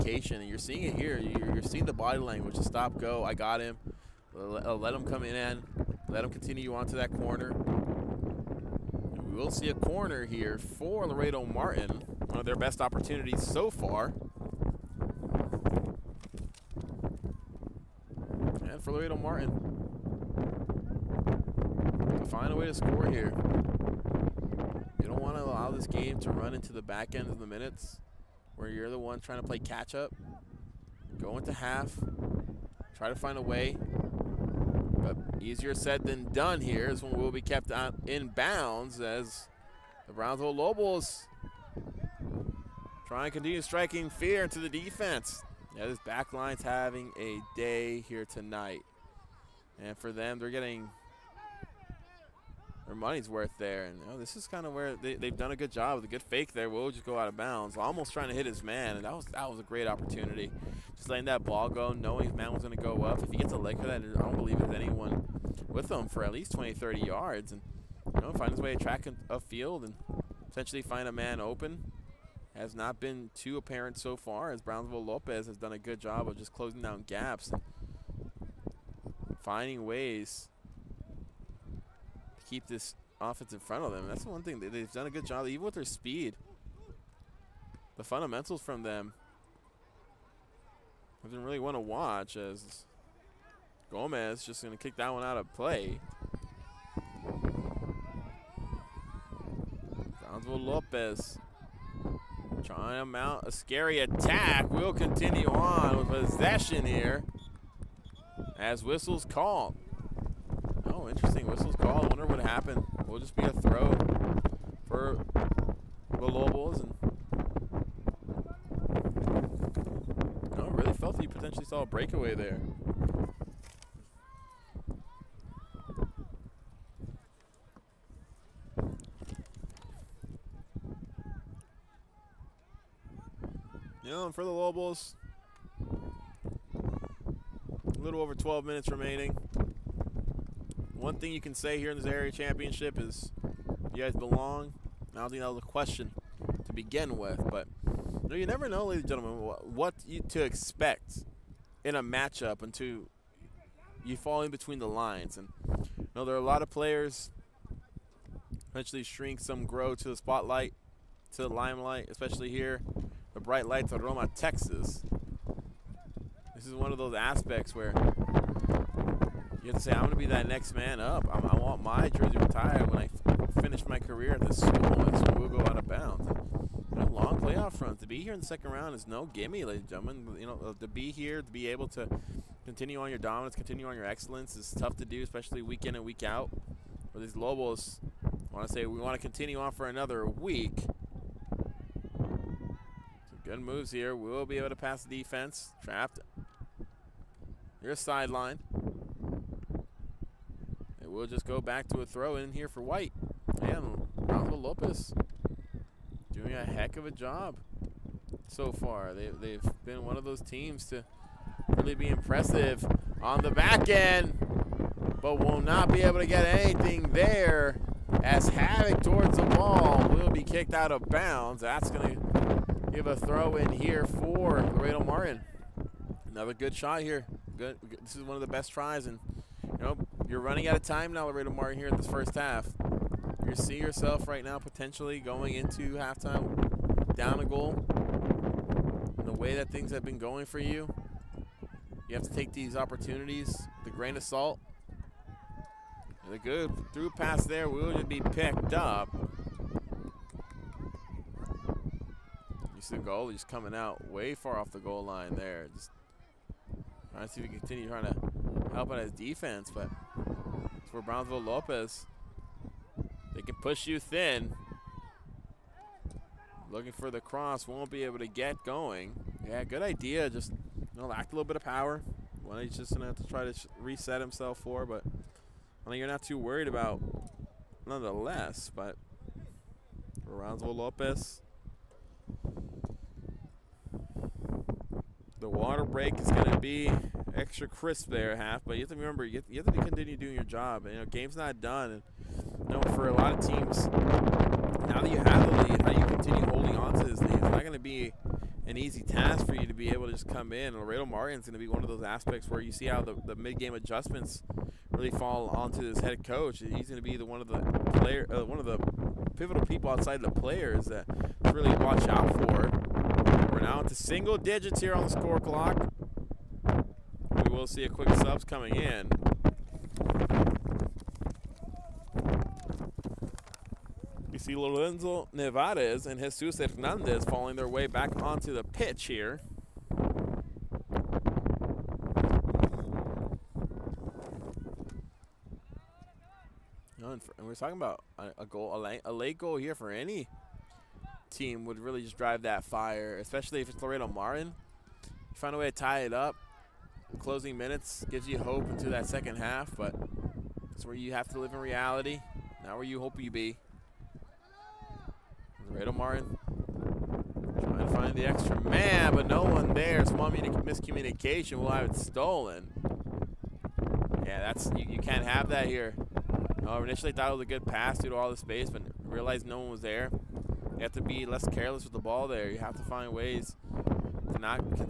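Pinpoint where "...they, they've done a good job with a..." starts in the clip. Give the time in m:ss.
0:54.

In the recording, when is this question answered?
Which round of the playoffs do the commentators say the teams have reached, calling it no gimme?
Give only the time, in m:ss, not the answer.
2:58.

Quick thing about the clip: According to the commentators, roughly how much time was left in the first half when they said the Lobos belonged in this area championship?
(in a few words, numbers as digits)
12 minutes.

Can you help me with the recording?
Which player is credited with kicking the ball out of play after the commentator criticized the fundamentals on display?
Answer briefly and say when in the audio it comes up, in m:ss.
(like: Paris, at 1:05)
Gomez, at 1:33.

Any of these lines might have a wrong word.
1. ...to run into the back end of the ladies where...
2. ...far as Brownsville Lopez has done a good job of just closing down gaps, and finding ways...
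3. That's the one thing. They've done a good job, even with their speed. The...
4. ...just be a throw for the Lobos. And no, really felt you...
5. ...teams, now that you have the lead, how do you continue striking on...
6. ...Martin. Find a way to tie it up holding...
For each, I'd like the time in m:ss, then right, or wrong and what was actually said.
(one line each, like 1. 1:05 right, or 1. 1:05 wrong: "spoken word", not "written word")
1. 0:26 wrong: "minutes", not "ladies"
2. 1:14 right
3. 1:24 right
4. 1:53 right
5. 4:53 wrong: "holding", not "striking"
6. 5:44 wrong: "closing", not "holding".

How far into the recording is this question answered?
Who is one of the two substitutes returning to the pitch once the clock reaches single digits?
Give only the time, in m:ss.
5:24.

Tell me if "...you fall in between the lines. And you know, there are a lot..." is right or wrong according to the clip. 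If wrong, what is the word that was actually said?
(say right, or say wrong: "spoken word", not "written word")
right.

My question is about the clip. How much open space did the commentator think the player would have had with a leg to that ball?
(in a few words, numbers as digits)
20 to 30 yards.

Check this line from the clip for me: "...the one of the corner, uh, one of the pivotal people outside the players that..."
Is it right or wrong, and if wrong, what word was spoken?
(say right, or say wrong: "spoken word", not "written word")
wrong: "player", not "corner".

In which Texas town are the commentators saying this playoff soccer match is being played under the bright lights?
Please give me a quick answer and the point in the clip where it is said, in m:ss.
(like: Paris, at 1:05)
Roma, Texas, at 2:44.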